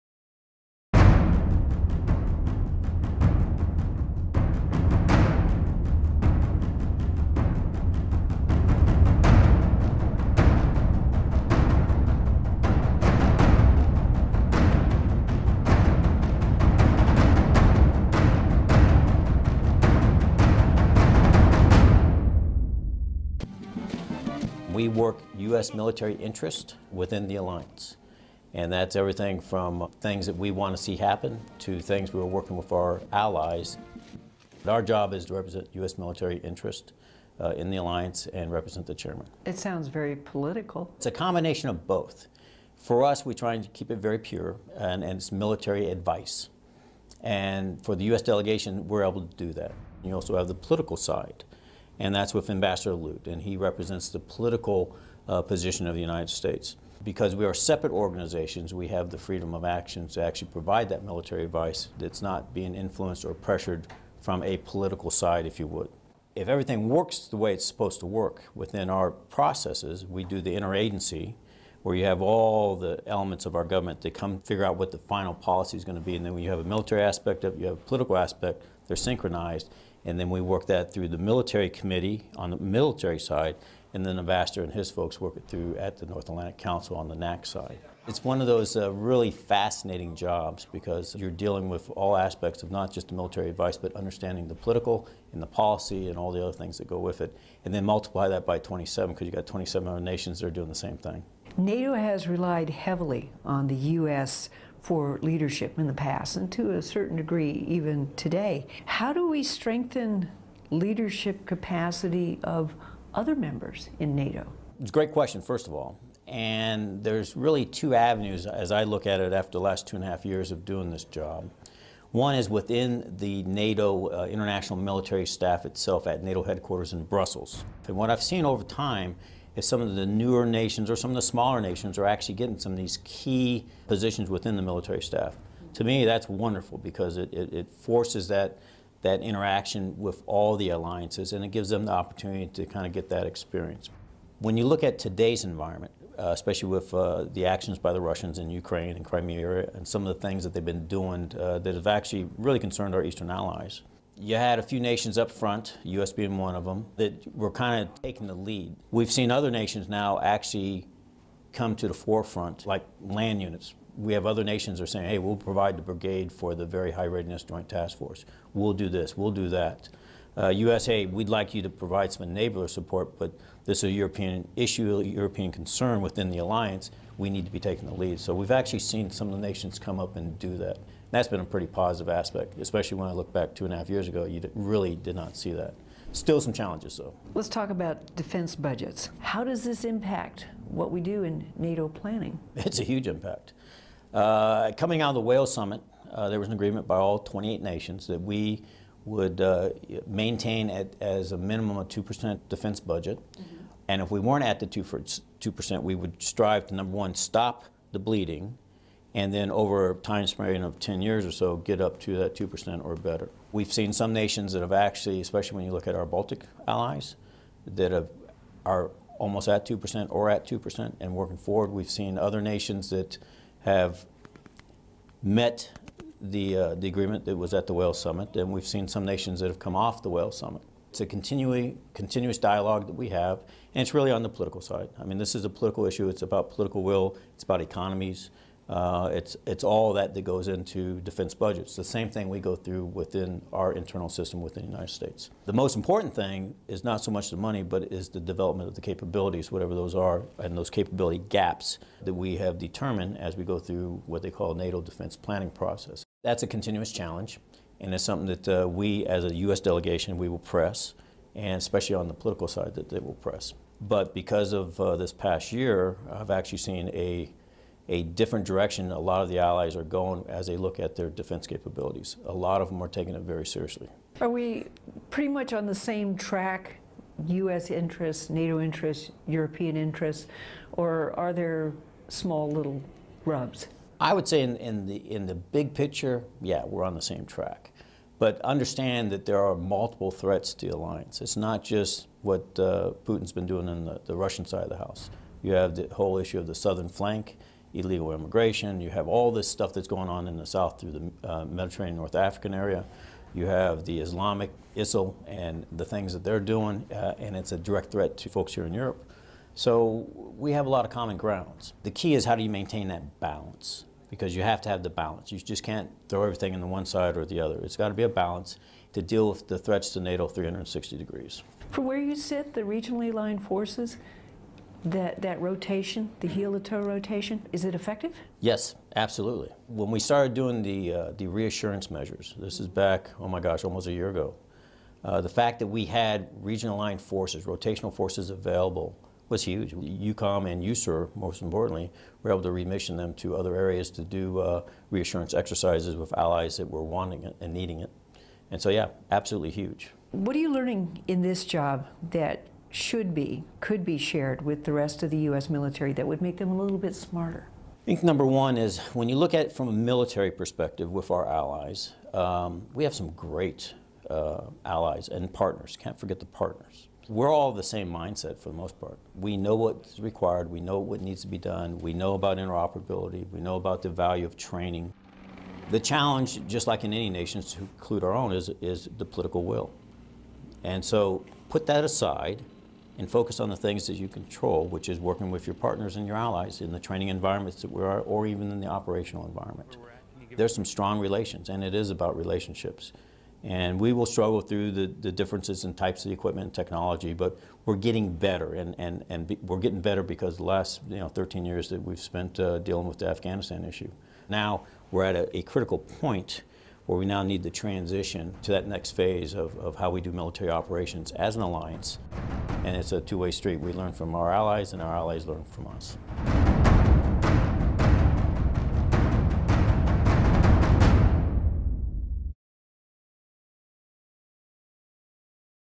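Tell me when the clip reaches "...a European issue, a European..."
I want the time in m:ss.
2:53.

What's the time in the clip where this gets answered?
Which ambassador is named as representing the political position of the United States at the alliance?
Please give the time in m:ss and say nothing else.
0:52.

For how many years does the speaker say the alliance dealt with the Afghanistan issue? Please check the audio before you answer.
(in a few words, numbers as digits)
13 years.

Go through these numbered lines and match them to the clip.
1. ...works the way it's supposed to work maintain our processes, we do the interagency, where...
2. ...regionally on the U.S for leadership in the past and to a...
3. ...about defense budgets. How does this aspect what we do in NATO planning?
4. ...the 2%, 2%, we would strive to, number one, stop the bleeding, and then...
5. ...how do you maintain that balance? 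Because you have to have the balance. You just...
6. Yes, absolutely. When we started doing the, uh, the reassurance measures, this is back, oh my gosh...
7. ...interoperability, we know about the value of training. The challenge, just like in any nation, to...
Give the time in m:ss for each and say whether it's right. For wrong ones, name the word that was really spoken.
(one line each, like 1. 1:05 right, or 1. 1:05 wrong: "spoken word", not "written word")
1. 1:06 wrong: "within", not "maintain"
2. 1:42 wrong: "heavily", not "regionally"
3. 3:07 wrong: "impact", not "aspect"
4. 3:24 right
5. 5:12 right
6. 5:28 right
7. 6:12 right.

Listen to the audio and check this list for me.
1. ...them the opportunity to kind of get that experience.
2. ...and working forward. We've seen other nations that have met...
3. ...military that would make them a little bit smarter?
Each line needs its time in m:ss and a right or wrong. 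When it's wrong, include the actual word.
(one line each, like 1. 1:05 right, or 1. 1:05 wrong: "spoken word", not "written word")
1. 2:21 right
2. 3:40 right
3. 5:55 right.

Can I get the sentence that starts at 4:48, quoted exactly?
But understand that there are multiple threats to the alliance.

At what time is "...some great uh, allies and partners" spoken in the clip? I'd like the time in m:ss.
6:02.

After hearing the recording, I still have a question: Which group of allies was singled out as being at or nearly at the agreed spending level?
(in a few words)
Baltic allies.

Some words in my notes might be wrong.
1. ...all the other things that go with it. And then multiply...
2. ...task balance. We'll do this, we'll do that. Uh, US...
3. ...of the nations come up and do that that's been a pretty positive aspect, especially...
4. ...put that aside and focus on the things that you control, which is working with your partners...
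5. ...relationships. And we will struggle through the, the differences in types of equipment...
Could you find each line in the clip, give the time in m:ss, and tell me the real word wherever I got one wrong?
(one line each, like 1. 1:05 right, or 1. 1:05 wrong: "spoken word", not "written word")
1. 1:36 right
2. 2:47 wrong: "force", not "balance"
3. 2:59 right
4. 6:21 right
5. 6:32 right.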